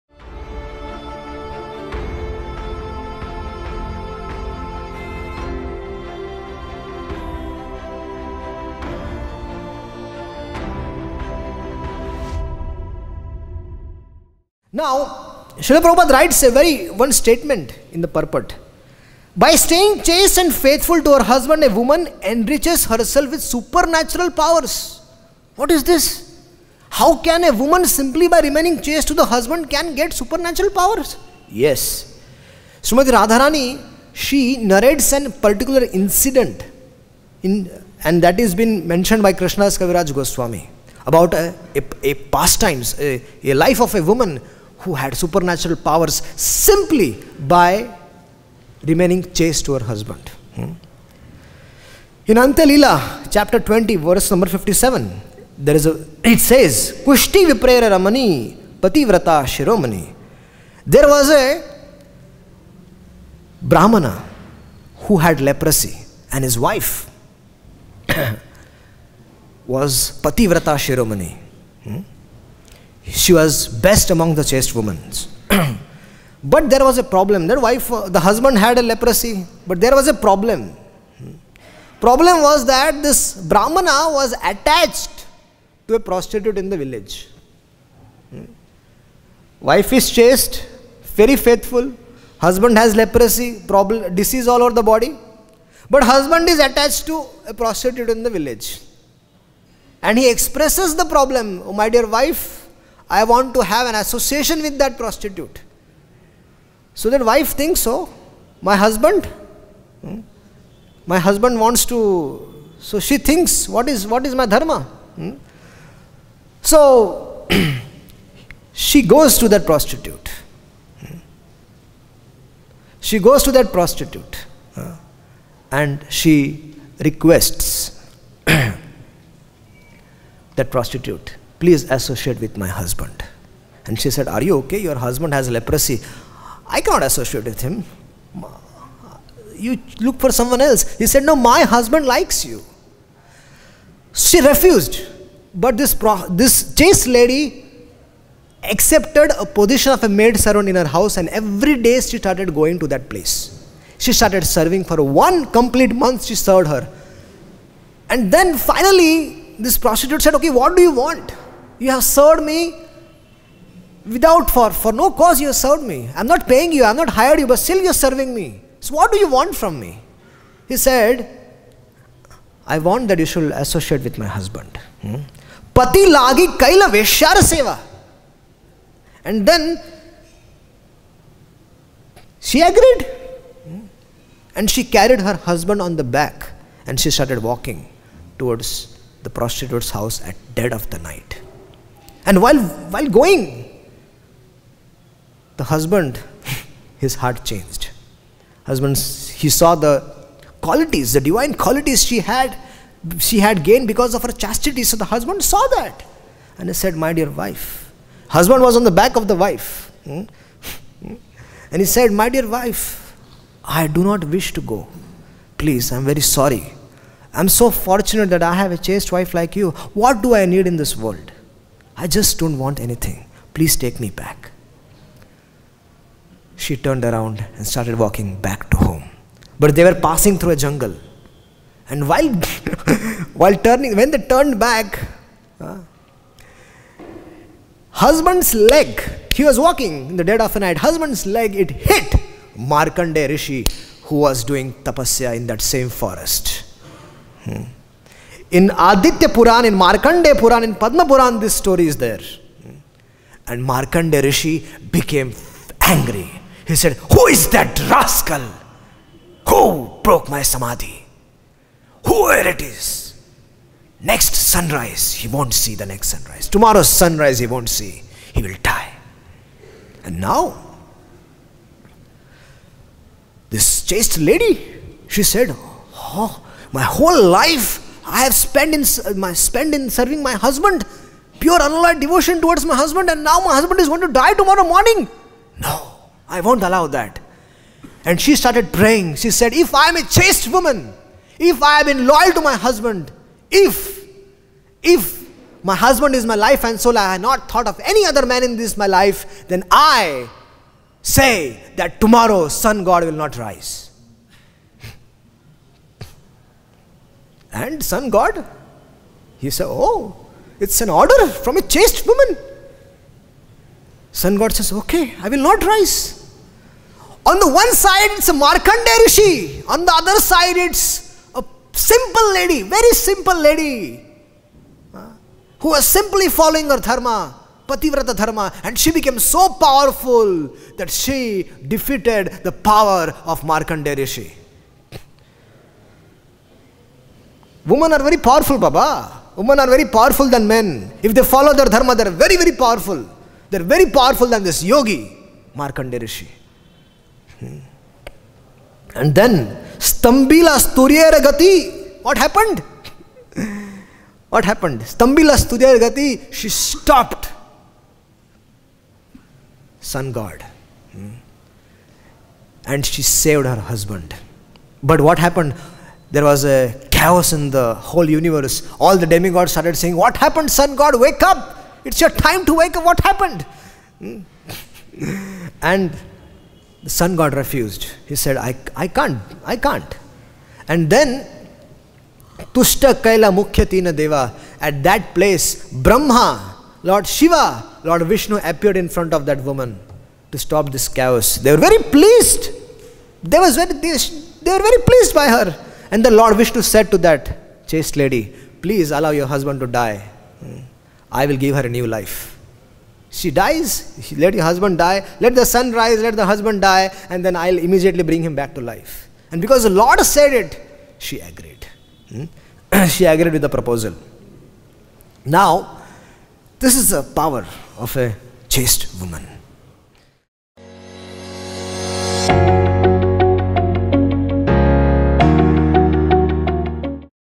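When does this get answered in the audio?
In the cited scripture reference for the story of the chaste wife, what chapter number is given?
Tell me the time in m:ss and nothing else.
0:53.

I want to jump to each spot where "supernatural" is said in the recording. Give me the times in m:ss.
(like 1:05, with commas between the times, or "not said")
0:23, 0:30, 0:45.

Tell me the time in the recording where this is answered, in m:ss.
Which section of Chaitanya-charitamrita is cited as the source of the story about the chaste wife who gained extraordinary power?
0:52.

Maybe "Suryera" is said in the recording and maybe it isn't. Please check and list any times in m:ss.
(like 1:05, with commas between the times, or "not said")
5:50, 5:55.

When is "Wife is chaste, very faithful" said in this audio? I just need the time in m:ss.
1:29.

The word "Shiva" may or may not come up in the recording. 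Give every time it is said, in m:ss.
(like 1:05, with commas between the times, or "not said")
6:27.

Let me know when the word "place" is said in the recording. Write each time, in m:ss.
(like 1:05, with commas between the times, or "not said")
2:33, 6:25.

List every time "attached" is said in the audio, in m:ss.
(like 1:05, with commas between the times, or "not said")
1:24, 1:36.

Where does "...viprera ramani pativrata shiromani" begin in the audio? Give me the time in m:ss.
0:57.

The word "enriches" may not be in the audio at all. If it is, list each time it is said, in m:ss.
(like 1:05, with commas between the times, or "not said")
0:22.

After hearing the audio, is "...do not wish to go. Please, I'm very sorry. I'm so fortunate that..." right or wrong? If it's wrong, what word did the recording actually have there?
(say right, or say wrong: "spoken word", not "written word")
right.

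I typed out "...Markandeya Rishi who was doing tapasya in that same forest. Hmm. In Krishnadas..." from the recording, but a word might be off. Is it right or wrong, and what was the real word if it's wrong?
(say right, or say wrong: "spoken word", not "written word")
wrong: "Aditya", not "Krishnadas".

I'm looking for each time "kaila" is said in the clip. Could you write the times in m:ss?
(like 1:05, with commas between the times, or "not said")
2:56, 6:22.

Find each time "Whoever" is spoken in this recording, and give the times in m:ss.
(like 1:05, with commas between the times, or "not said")
4:22.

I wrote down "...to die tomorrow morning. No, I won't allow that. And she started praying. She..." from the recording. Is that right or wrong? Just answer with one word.
right.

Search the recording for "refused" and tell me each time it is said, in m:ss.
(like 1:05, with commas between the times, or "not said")
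2:24, 6:17.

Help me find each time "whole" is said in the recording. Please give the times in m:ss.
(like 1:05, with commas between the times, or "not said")
4:36, 6:07.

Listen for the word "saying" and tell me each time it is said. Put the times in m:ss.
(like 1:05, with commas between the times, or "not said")
6:09.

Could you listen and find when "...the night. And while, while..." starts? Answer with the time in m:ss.
3:10.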